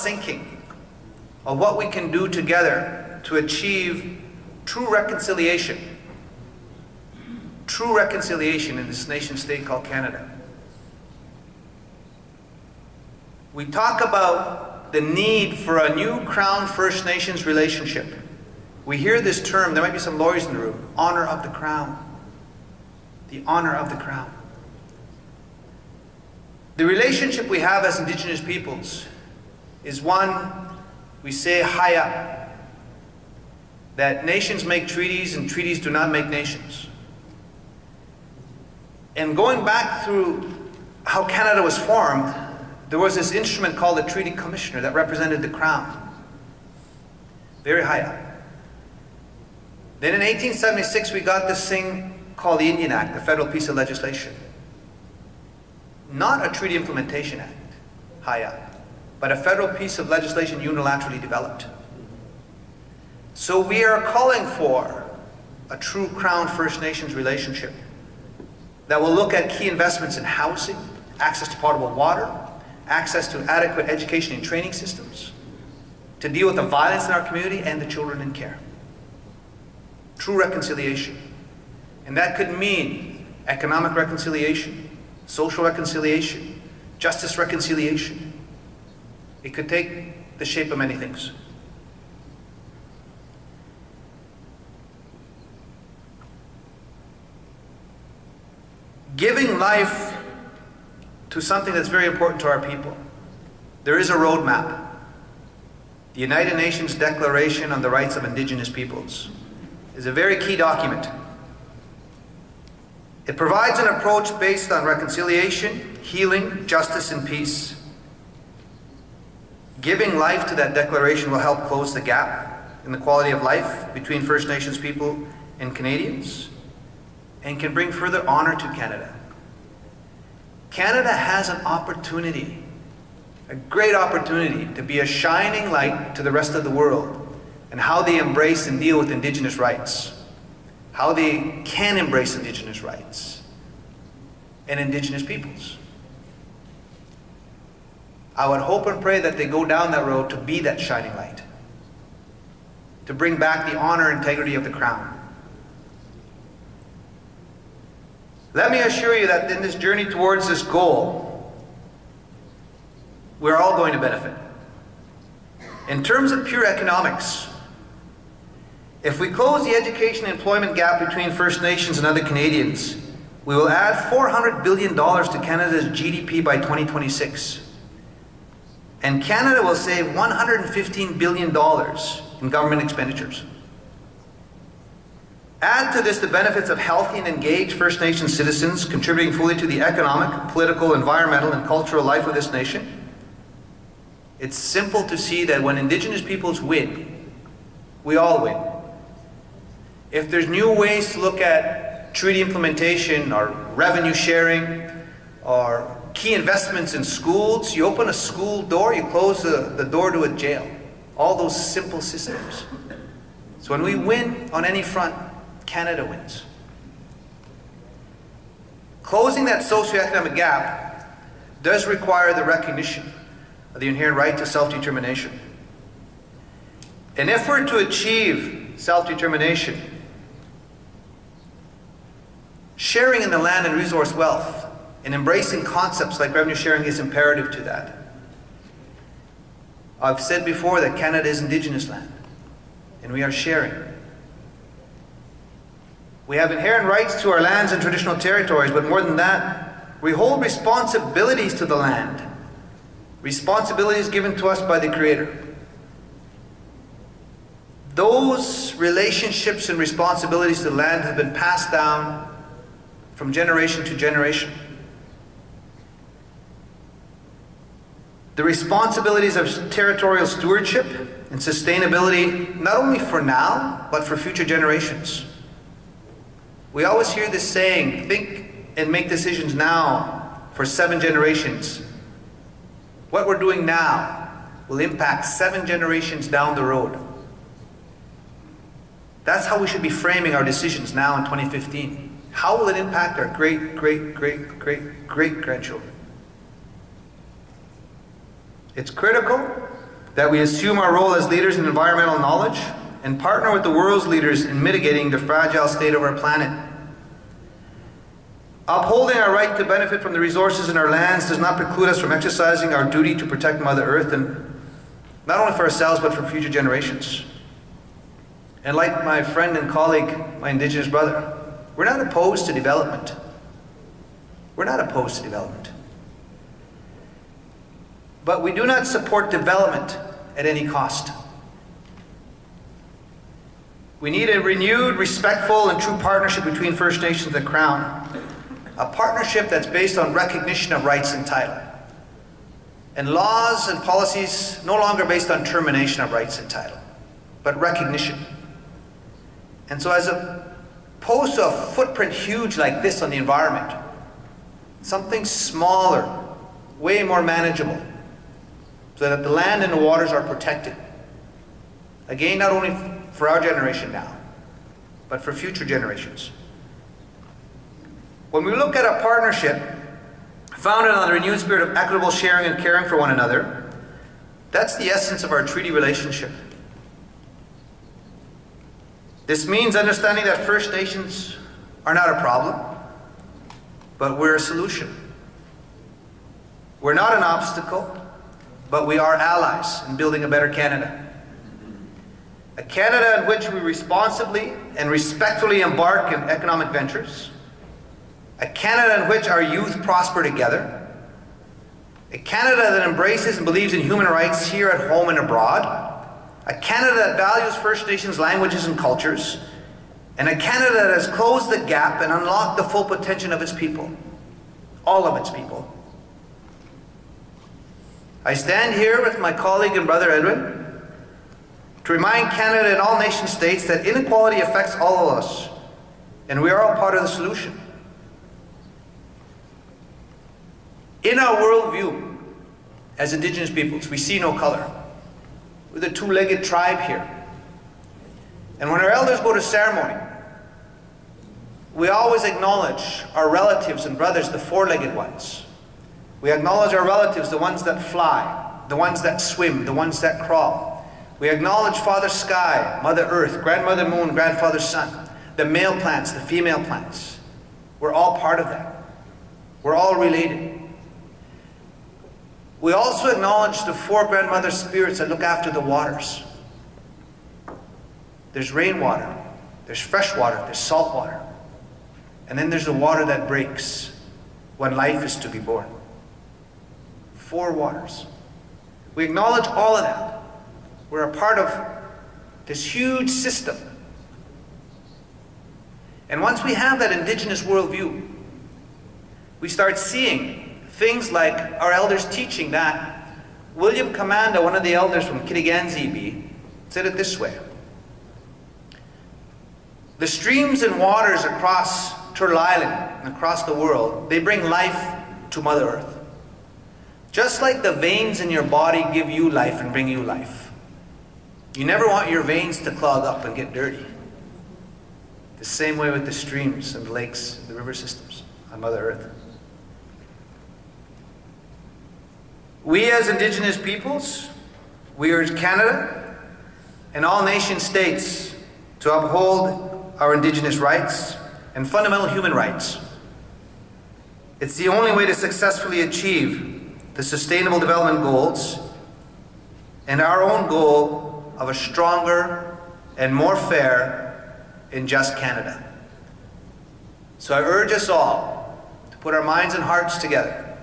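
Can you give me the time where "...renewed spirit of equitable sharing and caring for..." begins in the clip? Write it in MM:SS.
06:11.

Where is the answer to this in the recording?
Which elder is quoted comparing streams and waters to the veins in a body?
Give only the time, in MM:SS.
08:13.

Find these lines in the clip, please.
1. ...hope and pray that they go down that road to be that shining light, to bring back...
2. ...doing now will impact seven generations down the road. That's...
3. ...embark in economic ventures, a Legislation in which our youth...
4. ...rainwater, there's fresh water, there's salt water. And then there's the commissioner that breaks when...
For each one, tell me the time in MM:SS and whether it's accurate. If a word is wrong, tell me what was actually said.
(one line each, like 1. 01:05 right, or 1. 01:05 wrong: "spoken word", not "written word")
1. 02:28 right
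2. 04:43 right
3. 06:35 wrong: "Canada", not "Legislation"
4. 07:48 wrong: "water", not "commissioner".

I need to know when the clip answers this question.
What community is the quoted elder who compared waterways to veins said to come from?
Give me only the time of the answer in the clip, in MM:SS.
08:15.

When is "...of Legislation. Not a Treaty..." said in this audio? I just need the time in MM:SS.
00:53.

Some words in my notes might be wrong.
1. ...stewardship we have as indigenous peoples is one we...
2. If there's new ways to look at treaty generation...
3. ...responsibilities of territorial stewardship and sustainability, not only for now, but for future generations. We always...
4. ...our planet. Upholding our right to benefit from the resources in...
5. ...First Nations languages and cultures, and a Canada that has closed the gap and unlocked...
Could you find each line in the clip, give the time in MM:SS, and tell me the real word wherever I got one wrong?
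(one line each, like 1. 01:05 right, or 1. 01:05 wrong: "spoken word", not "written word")
1. 00:26 wrong: "relationship", not "stewardship"
2. 03:20 wrong: "implementation", not "generation"
3. 04:28 right
4. 05:06 right
5. 06:47 right.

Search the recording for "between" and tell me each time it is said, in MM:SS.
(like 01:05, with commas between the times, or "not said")
02:03, 02:51, 05:36.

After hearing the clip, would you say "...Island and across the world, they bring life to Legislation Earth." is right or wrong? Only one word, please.
wrong.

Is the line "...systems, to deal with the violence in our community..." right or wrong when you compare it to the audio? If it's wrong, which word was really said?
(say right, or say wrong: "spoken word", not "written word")
right.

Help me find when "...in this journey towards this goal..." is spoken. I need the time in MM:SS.
02:39.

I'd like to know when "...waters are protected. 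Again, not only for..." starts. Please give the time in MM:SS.
05:59.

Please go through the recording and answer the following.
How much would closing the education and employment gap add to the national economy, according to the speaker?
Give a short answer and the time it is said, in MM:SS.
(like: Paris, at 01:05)
$400 billion, at 02:54.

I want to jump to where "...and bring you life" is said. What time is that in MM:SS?
08:29.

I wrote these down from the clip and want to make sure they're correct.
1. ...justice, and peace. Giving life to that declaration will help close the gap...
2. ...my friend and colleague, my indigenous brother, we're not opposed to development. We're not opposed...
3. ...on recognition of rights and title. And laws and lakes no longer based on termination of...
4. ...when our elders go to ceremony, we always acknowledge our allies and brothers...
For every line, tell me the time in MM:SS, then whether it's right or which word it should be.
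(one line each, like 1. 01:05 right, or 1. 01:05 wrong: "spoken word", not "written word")
1. 01:56 right
2. 05:19 right
3. 05:39 wrong: "policies", not "lakes"
4. 07:18 wrong: "relatives", not "allies".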